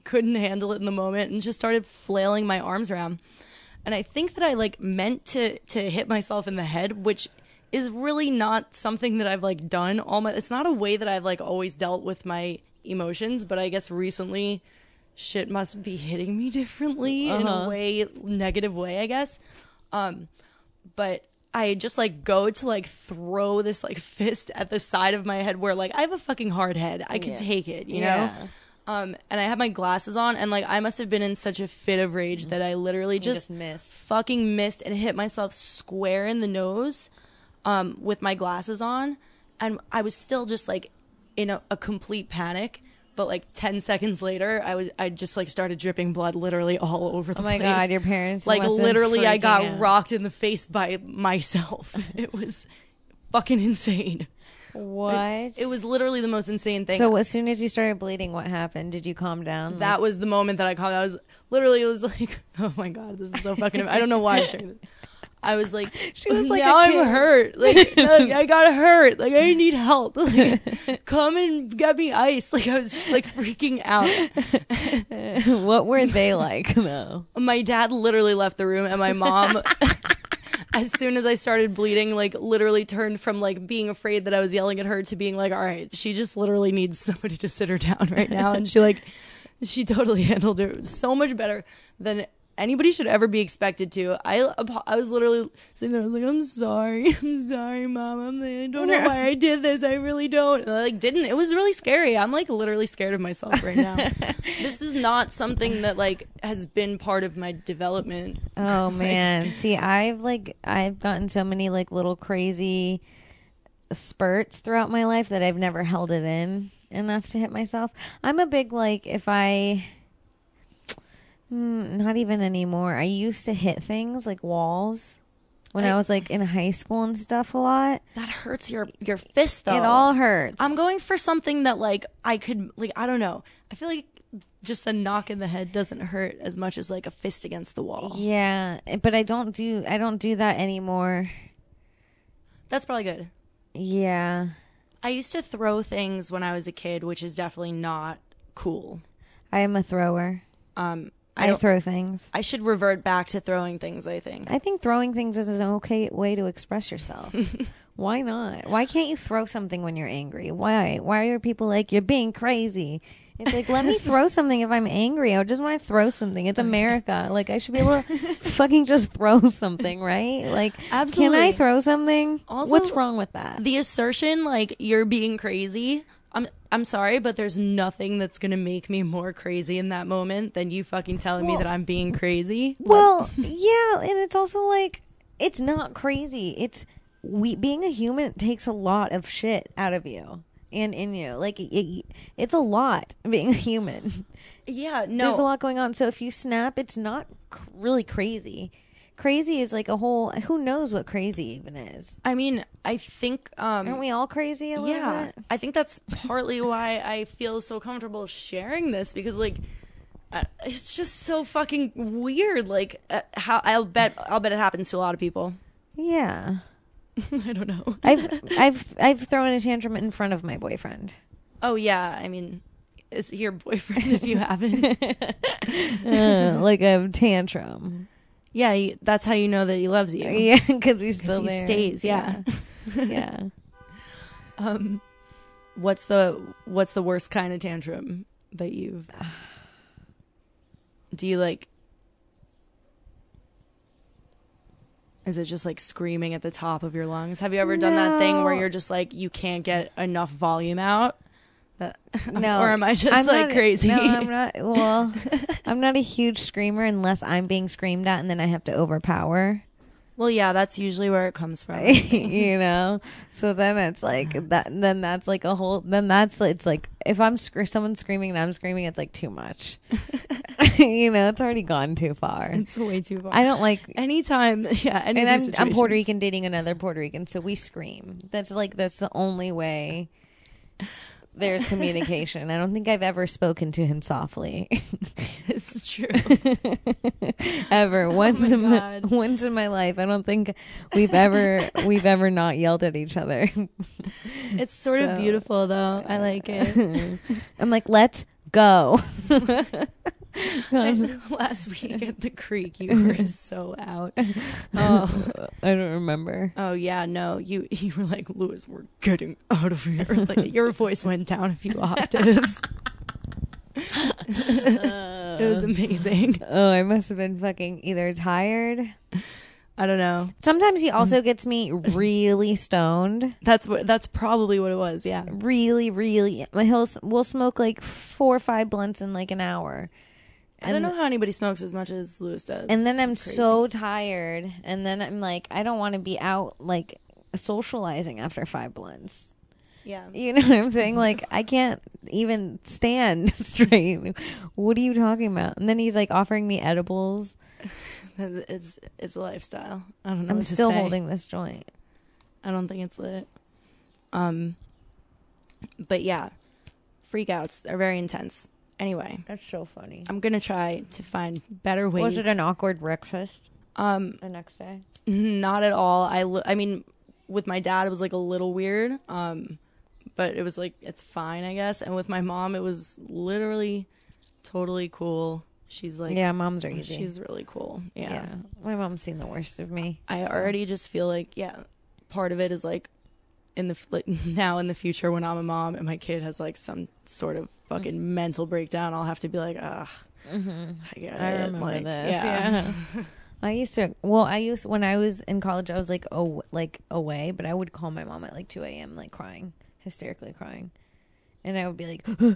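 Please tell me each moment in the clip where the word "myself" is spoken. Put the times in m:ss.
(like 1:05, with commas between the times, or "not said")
0:06, 0:35, 0:51, 1:43, 1:57.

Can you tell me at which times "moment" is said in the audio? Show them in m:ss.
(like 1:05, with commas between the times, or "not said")
0:00, 1:00, 3:00.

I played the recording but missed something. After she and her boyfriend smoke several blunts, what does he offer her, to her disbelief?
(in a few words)
edibles.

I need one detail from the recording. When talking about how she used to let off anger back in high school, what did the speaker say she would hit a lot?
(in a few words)
walls.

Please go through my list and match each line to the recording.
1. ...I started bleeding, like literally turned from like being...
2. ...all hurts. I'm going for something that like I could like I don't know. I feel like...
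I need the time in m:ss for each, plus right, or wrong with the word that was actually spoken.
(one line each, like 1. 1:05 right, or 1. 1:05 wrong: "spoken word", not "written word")
1. 1:21 right
2. 2:09 right.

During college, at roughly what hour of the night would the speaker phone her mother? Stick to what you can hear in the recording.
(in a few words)
2 a.m.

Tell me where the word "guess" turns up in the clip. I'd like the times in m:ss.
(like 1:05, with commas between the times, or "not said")
0:13, 0:19, 6:11.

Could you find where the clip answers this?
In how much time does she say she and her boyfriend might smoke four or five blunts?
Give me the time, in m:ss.
5:29.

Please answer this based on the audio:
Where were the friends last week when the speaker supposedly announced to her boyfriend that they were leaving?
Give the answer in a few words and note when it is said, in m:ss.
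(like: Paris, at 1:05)
the creek, at 5:02.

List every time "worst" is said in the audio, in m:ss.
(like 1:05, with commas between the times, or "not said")
3:57, 6:19.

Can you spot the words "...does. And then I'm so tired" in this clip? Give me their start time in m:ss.
5:32.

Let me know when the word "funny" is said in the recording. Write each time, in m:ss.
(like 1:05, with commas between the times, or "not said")
5:59.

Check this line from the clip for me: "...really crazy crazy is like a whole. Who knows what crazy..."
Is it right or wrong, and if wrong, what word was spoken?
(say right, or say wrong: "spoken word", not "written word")
right.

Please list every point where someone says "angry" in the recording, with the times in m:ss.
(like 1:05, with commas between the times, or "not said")
2:40, 2:44.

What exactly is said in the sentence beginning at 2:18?
Yeah, but I don't do I don't do that anymore.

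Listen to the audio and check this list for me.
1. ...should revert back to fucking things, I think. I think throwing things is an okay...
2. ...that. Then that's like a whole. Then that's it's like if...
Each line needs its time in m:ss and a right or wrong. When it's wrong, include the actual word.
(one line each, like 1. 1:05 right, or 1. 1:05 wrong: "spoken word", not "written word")
1. 2:32 wrong: "throwing", not "fucking"
2. 4:24 right.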